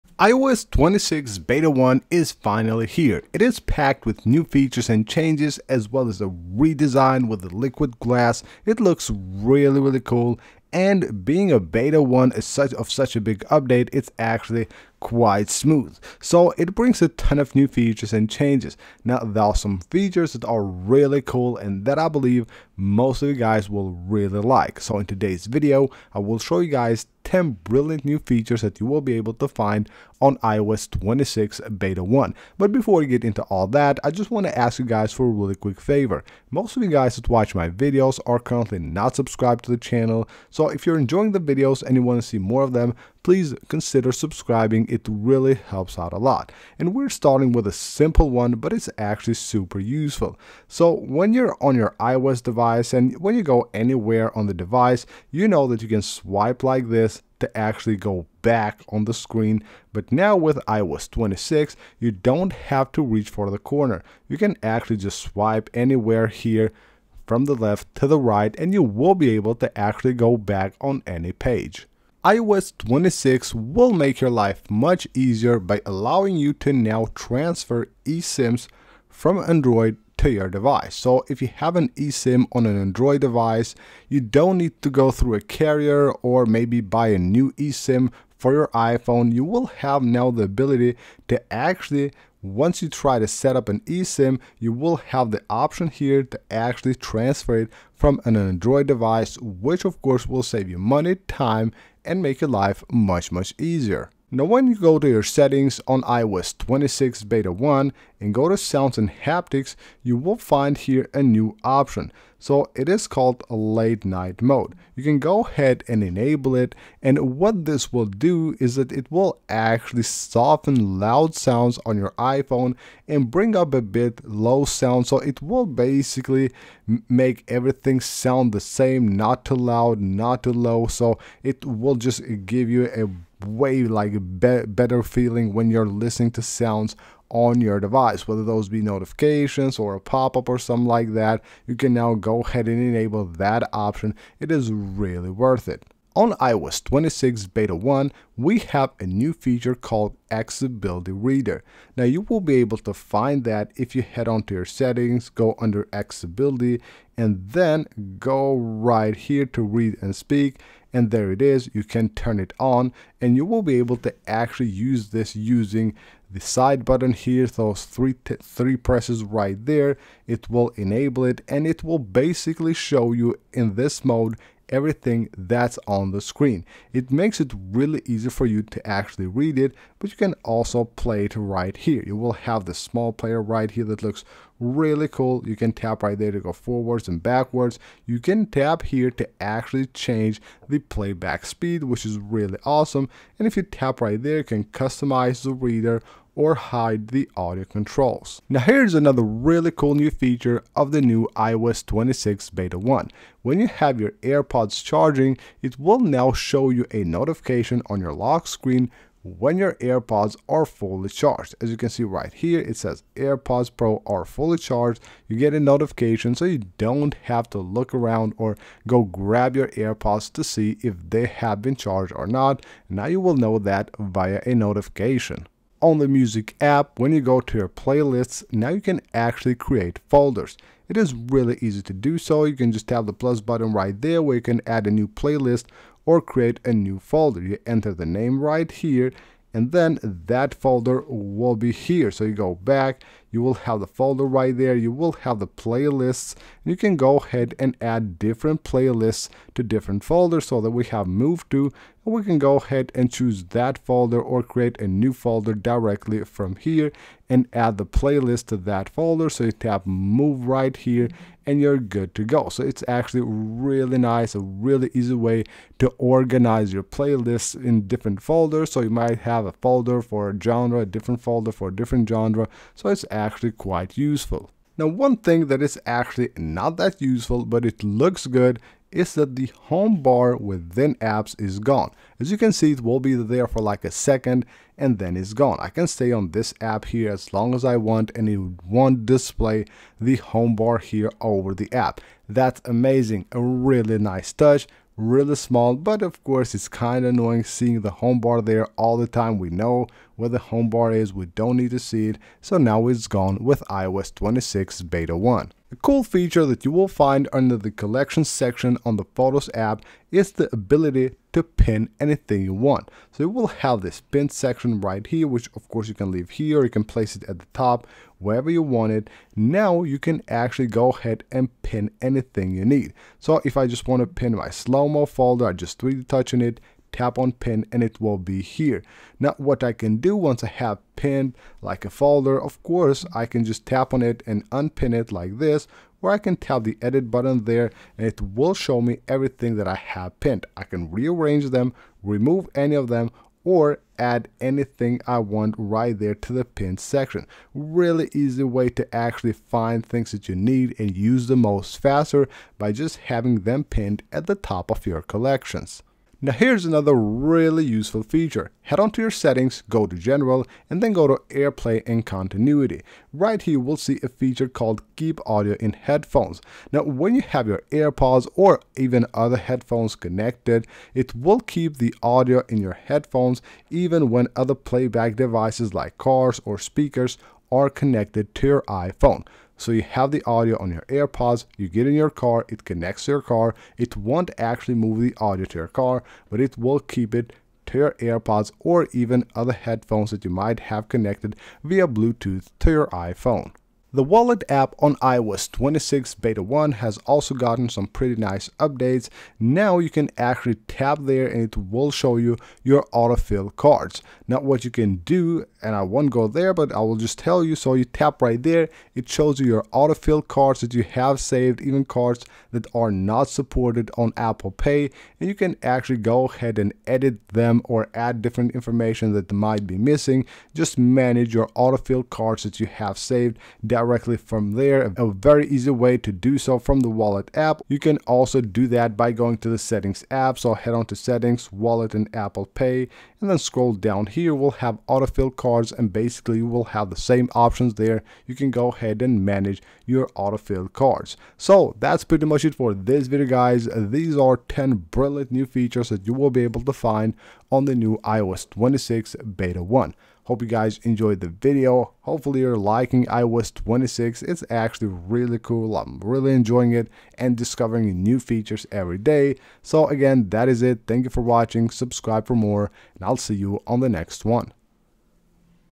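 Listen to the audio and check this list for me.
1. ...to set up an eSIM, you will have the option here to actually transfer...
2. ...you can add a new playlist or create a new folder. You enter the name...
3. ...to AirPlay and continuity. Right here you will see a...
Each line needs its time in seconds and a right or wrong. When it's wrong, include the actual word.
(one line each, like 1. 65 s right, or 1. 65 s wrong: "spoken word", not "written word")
1. 93 s right
2. 234 s right
3. 361 s right.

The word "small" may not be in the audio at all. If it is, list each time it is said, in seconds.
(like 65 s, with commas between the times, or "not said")
182 s, 295 s.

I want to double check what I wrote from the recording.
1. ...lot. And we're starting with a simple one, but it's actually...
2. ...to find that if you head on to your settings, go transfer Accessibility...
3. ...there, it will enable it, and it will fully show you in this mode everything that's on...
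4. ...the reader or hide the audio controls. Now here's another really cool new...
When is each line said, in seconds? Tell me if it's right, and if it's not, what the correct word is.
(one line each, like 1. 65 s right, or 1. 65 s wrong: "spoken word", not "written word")
1. 46 s right
2. 152 s wrong: "under", not "transfer"
3. 169 s wrong: "basically", not "fully"
4. 195 s right.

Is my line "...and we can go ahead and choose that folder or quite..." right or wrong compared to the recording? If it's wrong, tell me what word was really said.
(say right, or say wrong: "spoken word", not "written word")
wrong: "create", not "quite".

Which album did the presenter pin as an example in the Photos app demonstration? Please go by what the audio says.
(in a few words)
slow-mo.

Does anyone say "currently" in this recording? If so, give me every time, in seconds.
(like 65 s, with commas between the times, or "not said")
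38 s.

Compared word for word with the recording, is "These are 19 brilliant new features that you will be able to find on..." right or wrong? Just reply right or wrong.
wrong.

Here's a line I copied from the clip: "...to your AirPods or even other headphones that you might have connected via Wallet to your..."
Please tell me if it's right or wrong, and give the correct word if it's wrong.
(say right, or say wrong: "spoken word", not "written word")
wrong: "Bluetooth", not "Wallet".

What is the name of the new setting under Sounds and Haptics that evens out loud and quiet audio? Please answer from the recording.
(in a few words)
late night mode.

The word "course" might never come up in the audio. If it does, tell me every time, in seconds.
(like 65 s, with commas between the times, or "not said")
100 s, 296 s, 315 s, 332 s.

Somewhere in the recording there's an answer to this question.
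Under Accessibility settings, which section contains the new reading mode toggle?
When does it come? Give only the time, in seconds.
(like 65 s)
159 s.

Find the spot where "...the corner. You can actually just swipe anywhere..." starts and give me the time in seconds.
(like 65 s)
63 s.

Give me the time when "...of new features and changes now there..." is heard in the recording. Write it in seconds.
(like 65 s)
17 s.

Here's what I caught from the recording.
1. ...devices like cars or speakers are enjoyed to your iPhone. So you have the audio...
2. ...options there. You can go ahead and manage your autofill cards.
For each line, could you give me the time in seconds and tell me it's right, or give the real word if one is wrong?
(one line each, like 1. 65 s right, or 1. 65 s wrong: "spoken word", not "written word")
1. 375 s wrong: "connected", not "enjoyed"
2. 437 s right.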